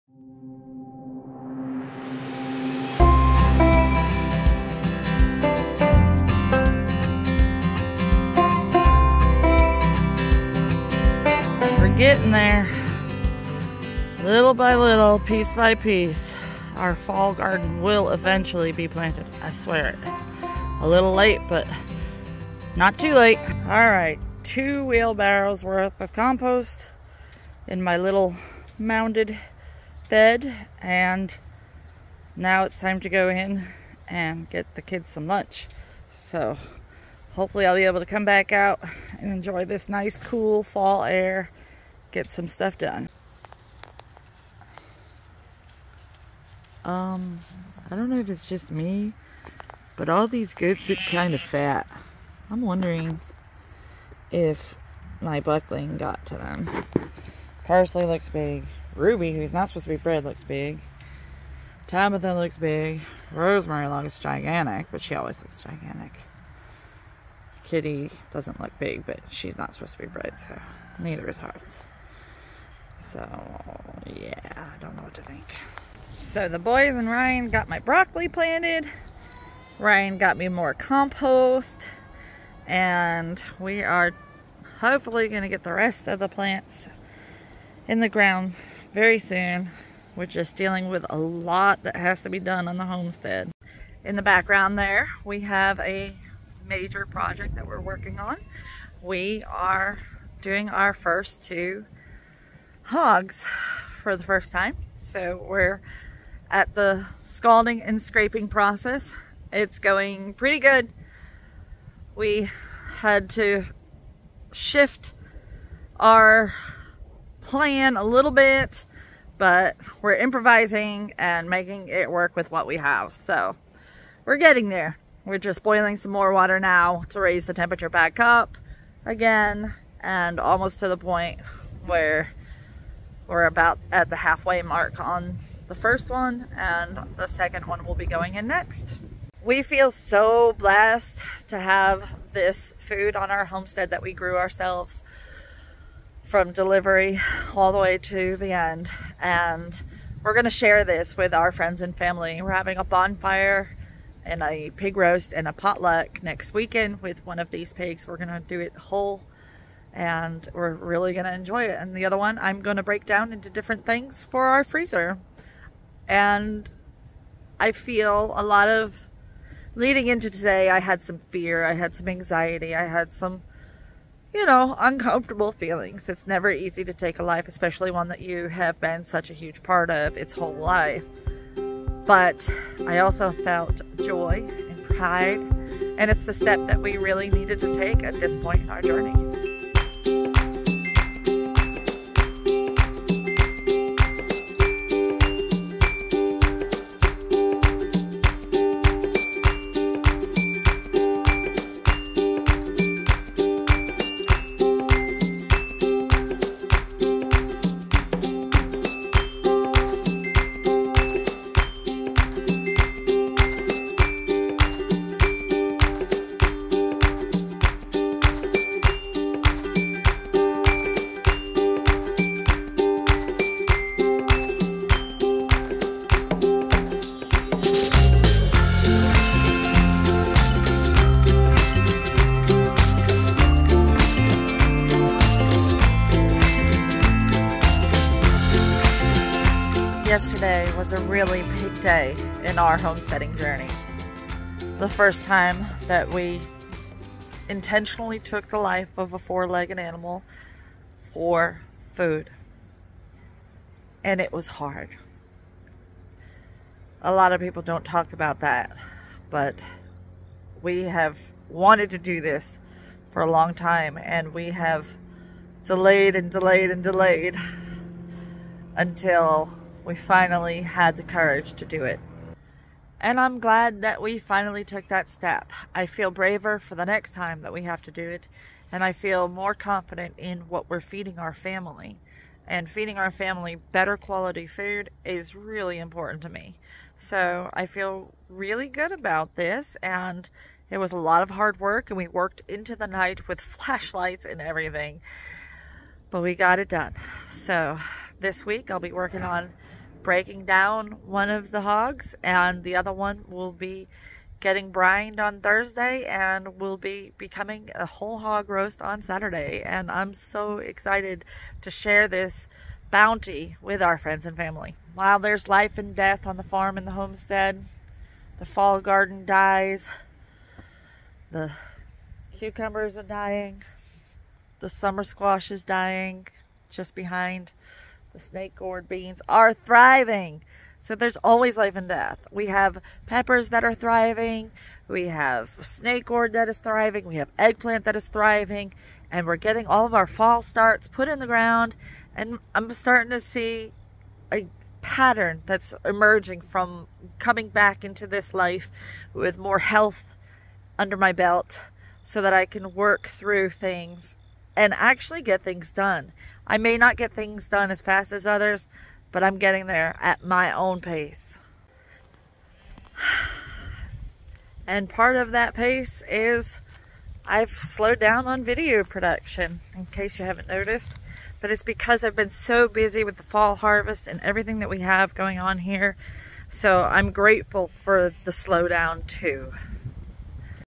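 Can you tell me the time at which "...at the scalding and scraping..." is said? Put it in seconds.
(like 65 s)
106 s.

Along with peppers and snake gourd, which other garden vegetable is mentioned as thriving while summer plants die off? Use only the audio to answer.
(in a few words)
Eggplant.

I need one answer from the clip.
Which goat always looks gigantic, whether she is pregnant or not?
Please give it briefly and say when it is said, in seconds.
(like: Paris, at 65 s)
Rosemary, at 63 s.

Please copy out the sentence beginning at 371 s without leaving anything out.
But it's because I've been so busy with the fall harvest and everything that we have going on here.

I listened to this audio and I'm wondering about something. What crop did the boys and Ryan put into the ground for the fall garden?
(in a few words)
Broccoli.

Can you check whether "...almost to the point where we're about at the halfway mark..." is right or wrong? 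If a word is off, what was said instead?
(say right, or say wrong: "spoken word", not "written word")
right.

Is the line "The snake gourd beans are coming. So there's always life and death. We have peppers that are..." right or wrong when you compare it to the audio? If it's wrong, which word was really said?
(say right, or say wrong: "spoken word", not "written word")
wrong: "thriving", not "coming".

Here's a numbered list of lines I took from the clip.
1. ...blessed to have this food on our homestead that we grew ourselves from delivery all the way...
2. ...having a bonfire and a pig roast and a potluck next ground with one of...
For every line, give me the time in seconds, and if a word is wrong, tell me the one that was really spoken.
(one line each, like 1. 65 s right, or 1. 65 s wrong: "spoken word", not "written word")
1. 140 s right
2. 152 s wrong: "weekend", not "ground".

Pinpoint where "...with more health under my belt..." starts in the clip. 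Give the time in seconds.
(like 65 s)
349 s.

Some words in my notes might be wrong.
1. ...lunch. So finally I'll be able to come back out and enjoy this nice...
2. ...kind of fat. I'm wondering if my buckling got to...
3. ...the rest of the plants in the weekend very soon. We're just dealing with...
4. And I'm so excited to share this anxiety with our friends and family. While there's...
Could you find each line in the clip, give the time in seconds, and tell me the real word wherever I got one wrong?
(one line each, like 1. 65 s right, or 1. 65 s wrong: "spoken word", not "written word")
1. 35 s wrong: "hopefully", not "finally"
2. 51 s right
3. 85 s wrong: "ground", not "weekend"
4. 309 s wrong: "bounty", not "anxiety".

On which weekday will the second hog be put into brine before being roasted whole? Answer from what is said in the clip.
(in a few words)
Thursday.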